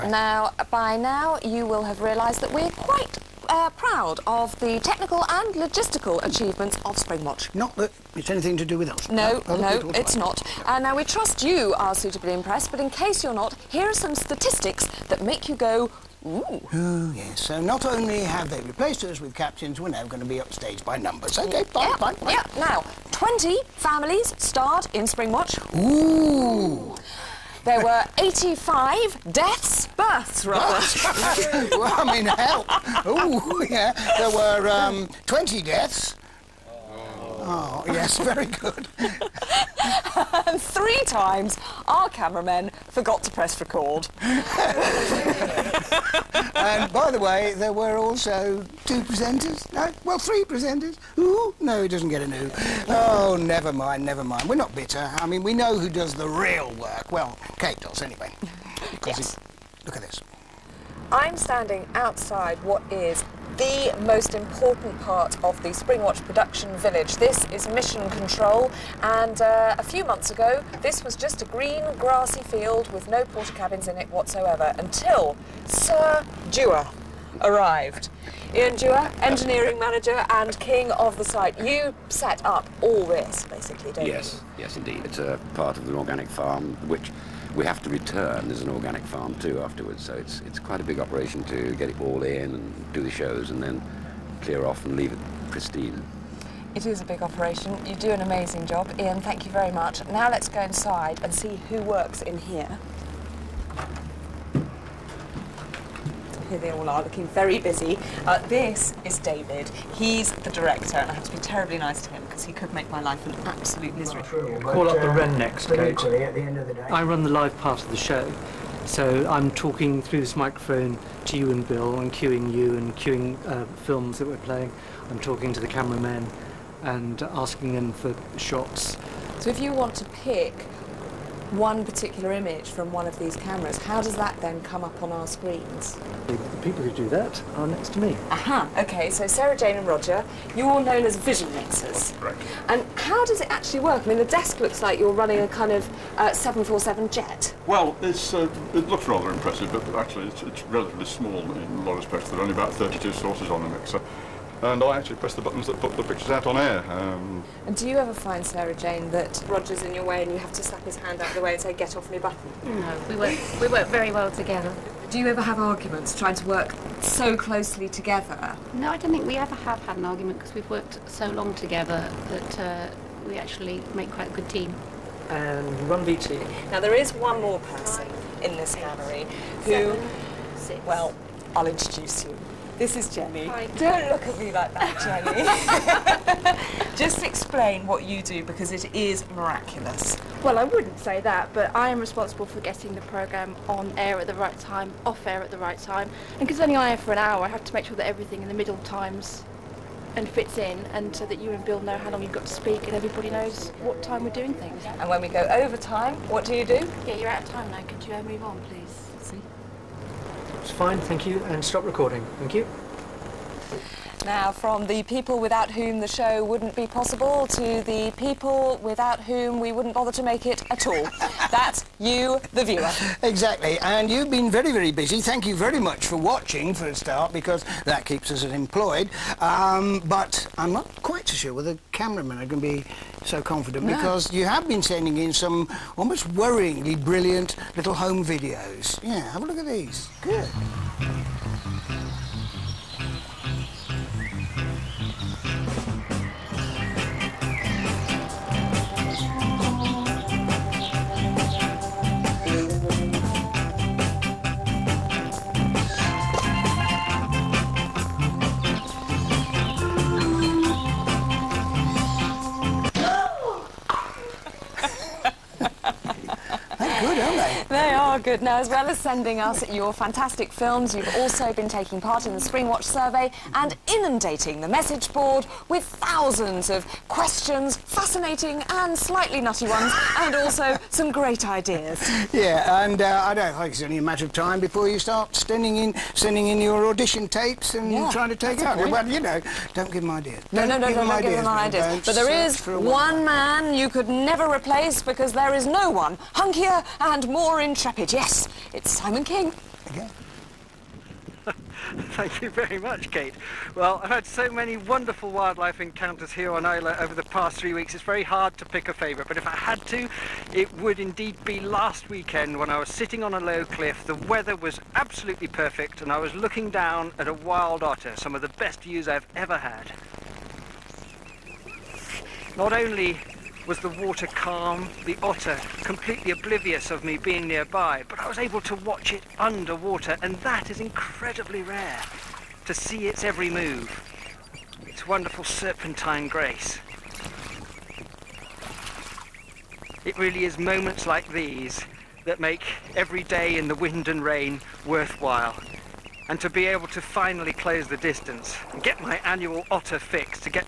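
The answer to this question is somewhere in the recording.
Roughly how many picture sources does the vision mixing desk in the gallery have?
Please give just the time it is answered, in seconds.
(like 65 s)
152 s.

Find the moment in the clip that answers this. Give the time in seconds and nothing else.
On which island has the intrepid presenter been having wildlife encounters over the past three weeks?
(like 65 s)
306 s.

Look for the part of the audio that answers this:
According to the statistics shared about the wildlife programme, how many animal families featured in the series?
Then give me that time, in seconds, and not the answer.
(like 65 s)
23 s.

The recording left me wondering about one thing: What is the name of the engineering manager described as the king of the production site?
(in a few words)
Ian Dewar.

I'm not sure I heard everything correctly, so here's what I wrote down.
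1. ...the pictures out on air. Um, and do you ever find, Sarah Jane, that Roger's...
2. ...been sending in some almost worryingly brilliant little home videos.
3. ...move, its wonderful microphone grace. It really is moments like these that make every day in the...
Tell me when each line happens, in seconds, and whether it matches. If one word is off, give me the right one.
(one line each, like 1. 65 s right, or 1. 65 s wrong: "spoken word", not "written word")
1. 155 s right
2. 234 s right
3. 333 s wrong: "serpentine", not "microphone".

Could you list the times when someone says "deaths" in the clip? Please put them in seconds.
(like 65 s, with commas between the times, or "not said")
29 s, 35 s.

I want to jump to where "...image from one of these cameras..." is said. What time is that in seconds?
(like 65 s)
132 s.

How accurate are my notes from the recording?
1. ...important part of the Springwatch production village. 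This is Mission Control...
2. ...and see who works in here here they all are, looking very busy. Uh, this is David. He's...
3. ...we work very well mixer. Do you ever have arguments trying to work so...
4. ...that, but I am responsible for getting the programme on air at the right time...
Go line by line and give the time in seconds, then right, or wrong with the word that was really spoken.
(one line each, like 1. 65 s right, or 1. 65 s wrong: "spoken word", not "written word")
1. 64 s right
2. 101 s right
3. 163 s wrong: "together", not "mixer"
4. 191 s right.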